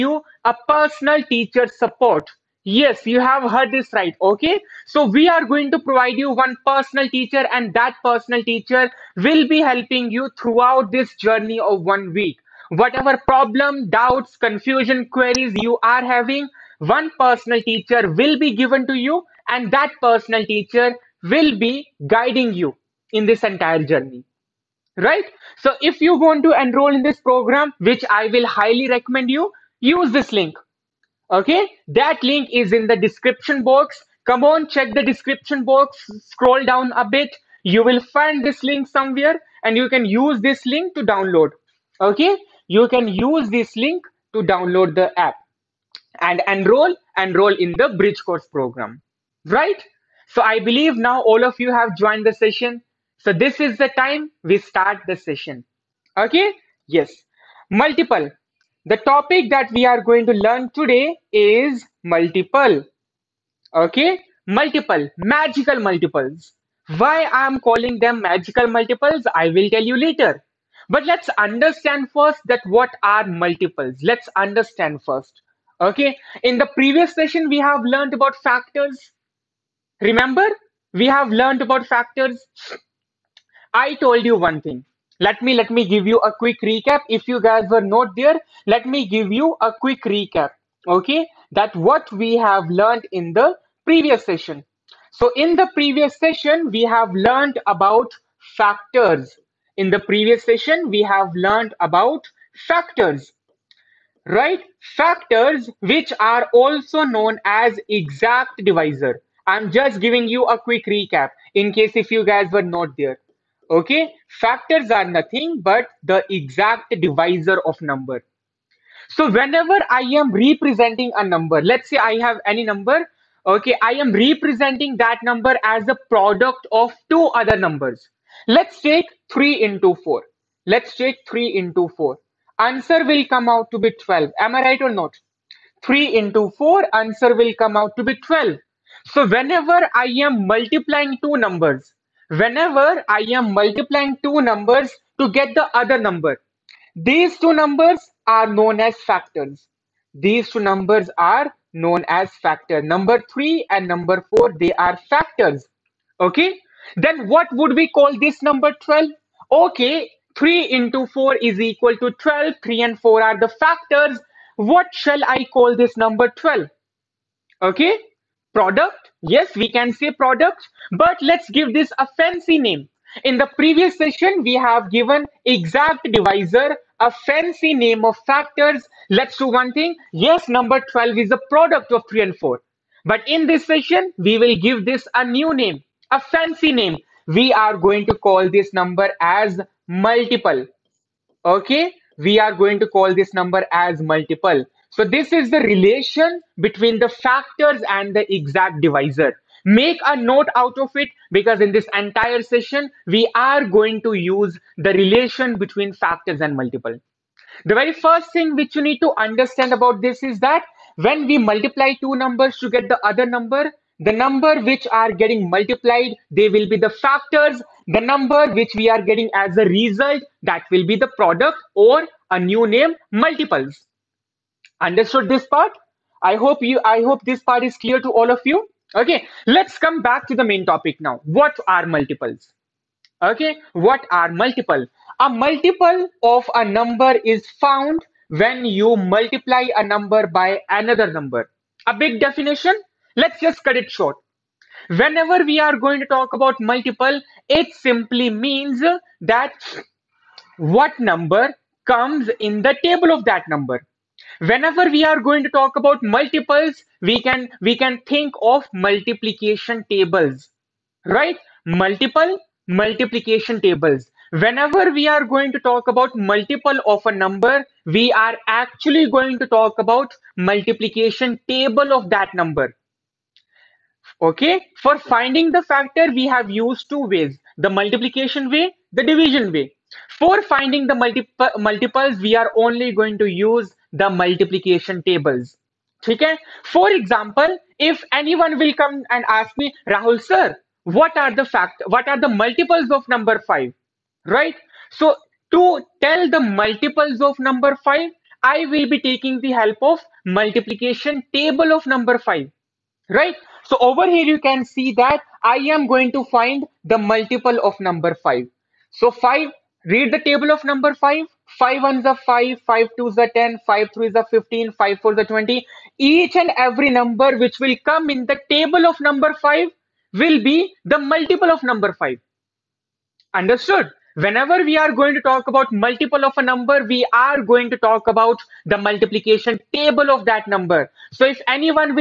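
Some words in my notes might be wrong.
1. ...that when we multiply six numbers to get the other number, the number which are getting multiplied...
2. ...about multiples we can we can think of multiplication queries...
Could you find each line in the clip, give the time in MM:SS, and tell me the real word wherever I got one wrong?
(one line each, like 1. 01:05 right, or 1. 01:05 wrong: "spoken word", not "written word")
1. 03:30 wrong: "two", not "six"
2. 04:15 wrong: "tables", not "queries".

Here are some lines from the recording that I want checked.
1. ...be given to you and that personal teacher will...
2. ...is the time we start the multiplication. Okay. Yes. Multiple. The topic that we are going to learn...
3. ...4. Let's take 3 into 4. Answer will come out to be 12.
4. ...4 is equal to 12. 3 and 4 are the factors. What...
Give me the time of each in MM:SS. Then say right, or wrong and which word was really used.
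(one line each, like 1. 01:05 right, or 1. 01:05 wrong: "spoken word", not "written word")
1. 00:18 right
2. 00:53 wrong: "session", not "multiplication"
3. 02:10 right
4. 02:41 right.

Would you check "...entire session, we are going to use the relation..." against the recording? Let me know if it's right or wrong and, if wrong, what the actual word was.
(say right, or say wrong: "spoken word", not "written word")
right.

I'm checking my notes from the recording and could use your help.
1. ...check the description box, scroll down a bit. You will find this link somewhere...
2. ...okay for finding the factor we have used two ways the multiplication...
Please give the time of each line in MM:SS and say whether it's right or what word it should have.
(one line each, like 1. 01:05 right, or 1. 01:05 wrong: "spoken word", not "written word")
1. 00:34 right
2. 04:34 right.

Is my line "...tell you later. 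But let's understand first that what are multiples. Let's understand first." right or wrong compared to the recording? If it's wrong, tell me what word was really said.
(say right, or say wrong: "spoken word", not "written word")
right.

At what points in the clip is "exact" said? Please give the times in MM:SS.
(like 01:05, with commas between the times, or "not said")
01:47, 01:56, 02:55, 03:18.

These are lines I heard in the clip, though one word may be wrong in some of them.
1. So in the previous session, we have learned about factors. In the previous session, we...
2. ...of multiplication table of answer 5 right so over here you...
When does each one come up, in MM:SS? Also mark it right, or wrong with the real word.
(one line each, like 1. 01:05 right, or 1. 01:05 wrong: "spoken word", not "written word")
1. 01:35 right
2. 04:59 wrong: "number", not "answer".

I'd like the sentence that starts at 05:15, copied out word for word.
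Each and every number which will come in the table of number 5 will be the multiple of number 5.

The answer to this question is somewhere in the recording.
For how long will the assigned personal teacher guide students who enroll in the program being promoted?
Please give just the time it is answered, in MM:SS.
00:11.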